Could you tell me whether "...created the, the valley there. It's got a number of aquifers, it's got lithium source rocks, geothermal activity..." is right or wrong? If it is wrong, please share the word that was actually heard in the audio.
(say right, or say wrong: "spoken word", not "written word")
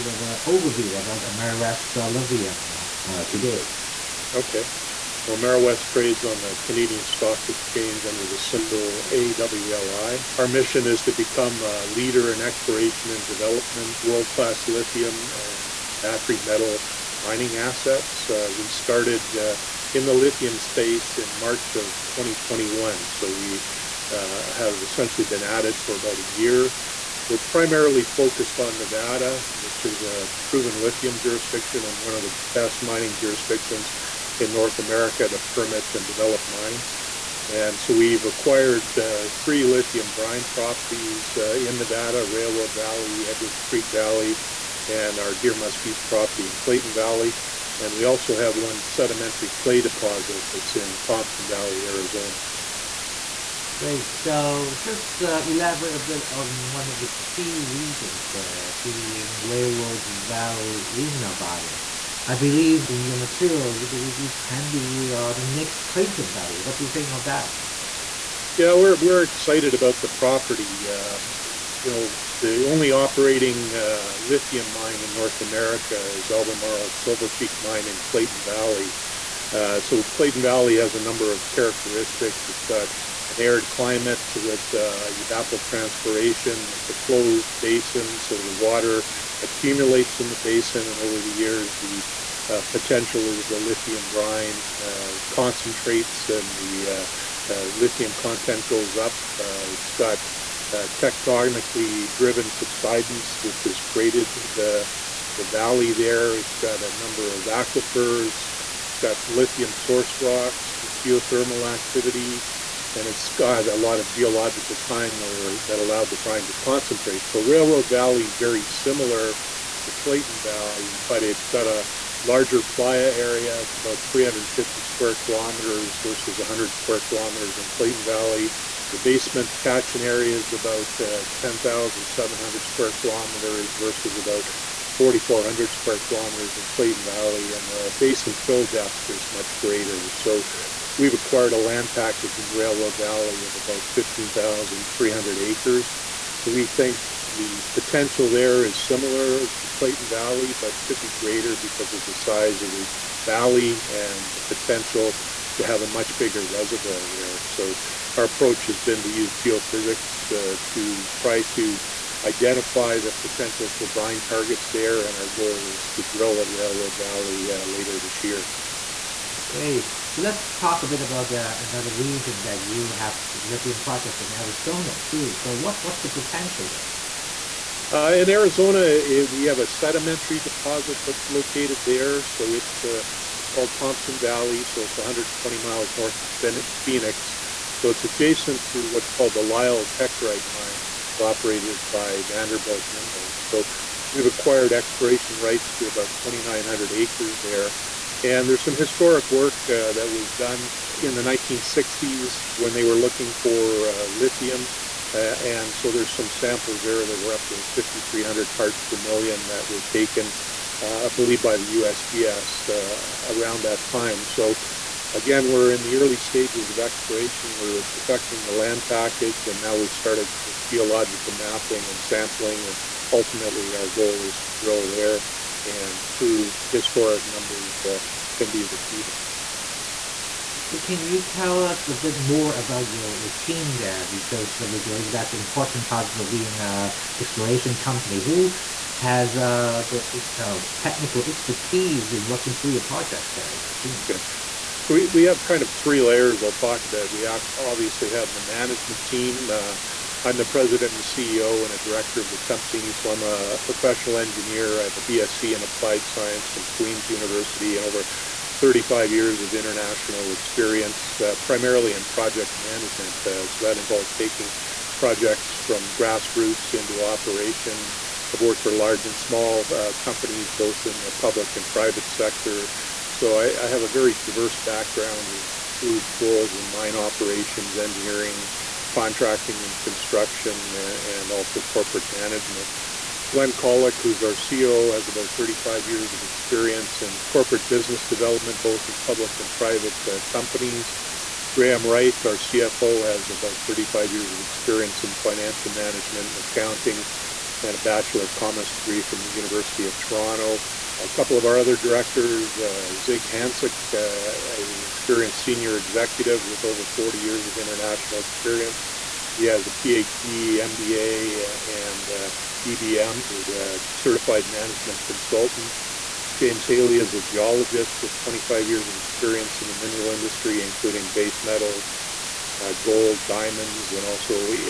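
right.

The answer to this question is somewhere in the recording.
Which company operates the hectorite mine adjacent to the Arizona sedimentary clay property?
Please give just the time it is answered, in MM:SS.
03:12.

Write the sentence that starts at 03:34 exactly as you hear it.
So again, we're in the early stages of exploration.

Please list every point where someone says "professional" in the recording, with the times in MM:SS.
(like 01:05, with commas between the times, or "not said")
04:13.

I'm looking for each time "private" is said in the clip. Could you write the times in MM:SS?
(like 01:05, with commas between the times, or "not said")
04:31, 04:49.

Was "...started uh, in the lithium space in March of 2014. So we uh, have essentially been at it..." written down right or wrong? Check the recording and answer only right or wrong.
wrong.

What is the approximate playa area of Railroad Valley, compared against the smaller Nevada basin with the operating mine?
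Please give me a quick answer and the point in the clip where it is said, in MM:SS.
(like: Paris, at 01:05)
350 square kilometers, at 02:04.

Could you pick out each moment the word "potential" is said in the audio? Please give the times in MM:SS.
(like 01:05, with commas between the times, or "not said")
01:32, 02:27, 02:34, 02:43, 02:56.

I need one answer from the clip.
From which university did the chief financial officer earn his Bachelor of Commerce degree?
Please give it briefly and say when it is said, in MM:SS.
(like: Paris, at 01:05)
University of Toronto, at 04:59.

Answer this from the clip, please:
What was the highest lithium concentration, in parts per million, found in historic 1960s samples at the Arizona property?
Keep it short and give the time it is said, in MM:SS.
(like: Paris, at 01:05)
5,300, at 03:27.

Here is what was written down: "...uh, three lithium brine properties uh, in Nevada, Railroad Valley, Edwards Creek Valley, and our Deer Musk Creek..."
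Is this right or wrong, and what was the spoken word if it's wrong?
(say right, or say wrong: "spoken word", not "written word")
wrong: "East", not "Creek".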